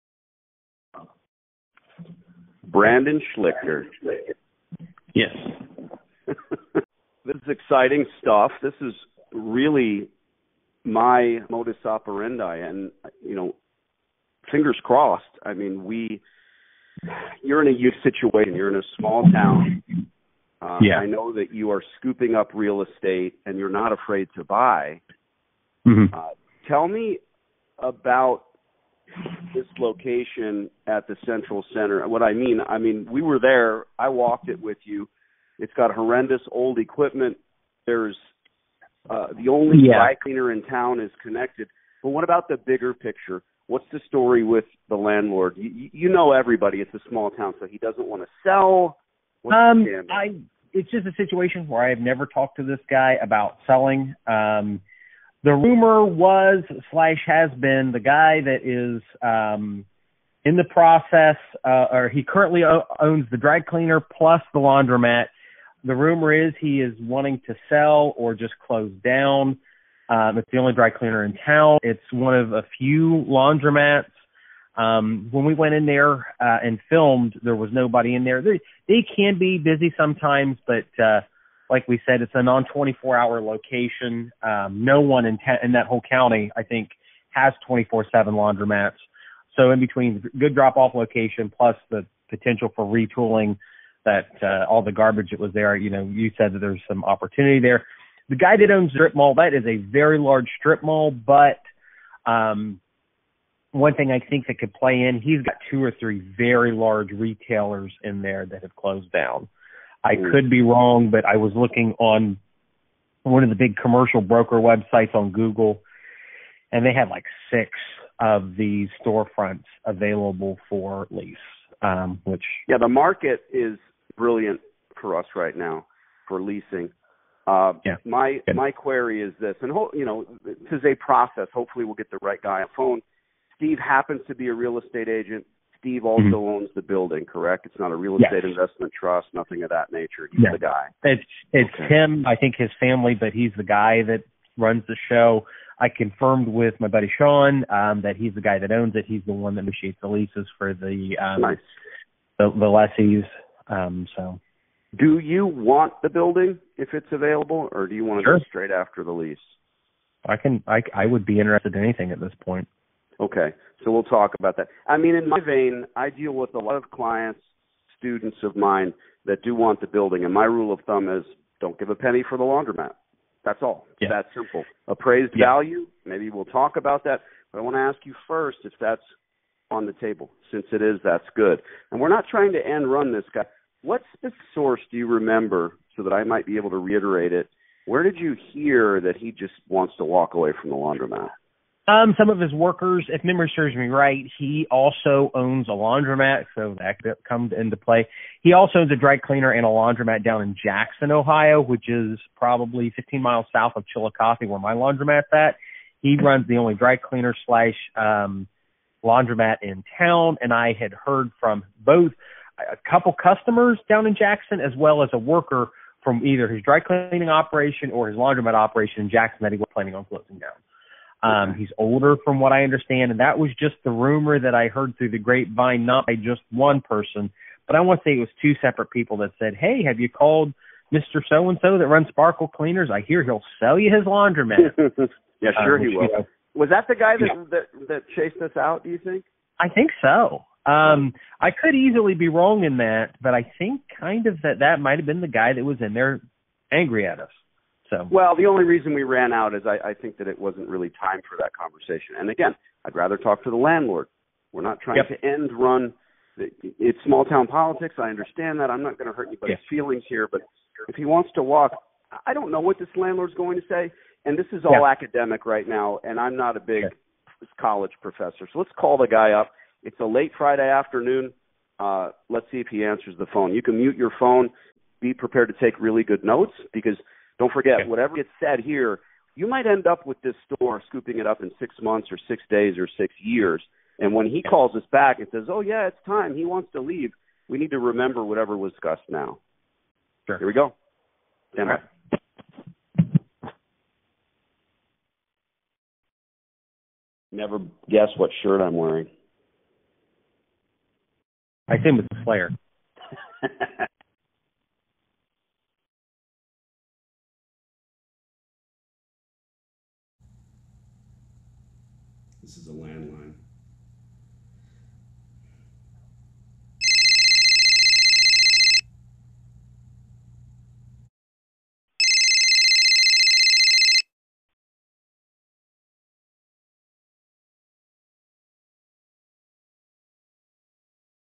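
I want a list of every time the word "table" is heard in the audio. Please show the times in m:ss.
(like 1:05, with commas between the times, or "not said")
2:59.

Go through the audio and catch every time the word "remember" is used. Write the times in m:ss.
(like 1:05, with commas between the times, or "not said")
3:05, 4:47.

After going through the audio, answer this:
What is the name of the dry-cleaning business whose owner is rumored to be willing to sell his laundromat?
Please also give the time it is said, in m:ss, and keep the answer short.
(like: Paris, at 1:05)
Sparkle Cleaners, at 3:52.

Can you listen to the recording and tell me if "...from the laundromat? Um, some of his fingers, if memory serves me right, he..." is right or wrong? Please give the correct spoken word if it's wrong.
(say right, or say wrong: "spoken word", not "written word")
wrong: "workers", not "fingers".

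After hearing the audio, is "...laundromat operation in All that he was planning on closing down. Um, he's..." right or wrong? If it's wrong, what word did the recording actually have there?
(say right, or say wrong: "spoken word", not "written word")
wrong: "Jackson", not "All".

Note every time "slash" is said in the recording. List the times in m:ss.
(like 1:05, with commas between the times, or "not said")
0:56, 3:27.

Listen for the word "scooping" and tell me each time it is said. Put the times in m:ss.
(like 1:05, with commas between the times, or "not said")
0:21, 4:40.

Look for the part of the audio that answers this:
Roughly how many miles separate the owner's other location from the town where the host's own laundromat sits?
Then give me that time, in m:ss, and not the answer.
3:22.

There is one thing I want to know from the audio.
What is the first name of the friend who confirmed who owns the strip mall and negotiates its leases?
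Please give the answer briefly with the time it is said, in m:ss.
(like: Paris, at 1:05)
Sean, at 2:27.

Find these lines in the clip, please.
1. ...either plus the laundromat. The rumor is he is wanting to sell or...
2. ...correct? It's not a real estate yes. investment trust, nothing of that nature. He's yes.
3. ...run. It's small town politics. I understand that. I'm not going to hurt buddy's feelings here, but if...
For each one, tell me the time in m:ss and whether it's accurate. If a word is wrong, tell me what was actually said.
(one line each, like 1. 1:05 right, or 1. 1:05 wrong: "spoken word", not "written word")
1. 1:03 wrong: "cleaner", not "either"
2. 2:17 right
3. 4:15 wrong: "anybody", not "buddy".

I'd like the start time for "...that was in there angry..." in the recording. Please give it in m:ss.
4:05.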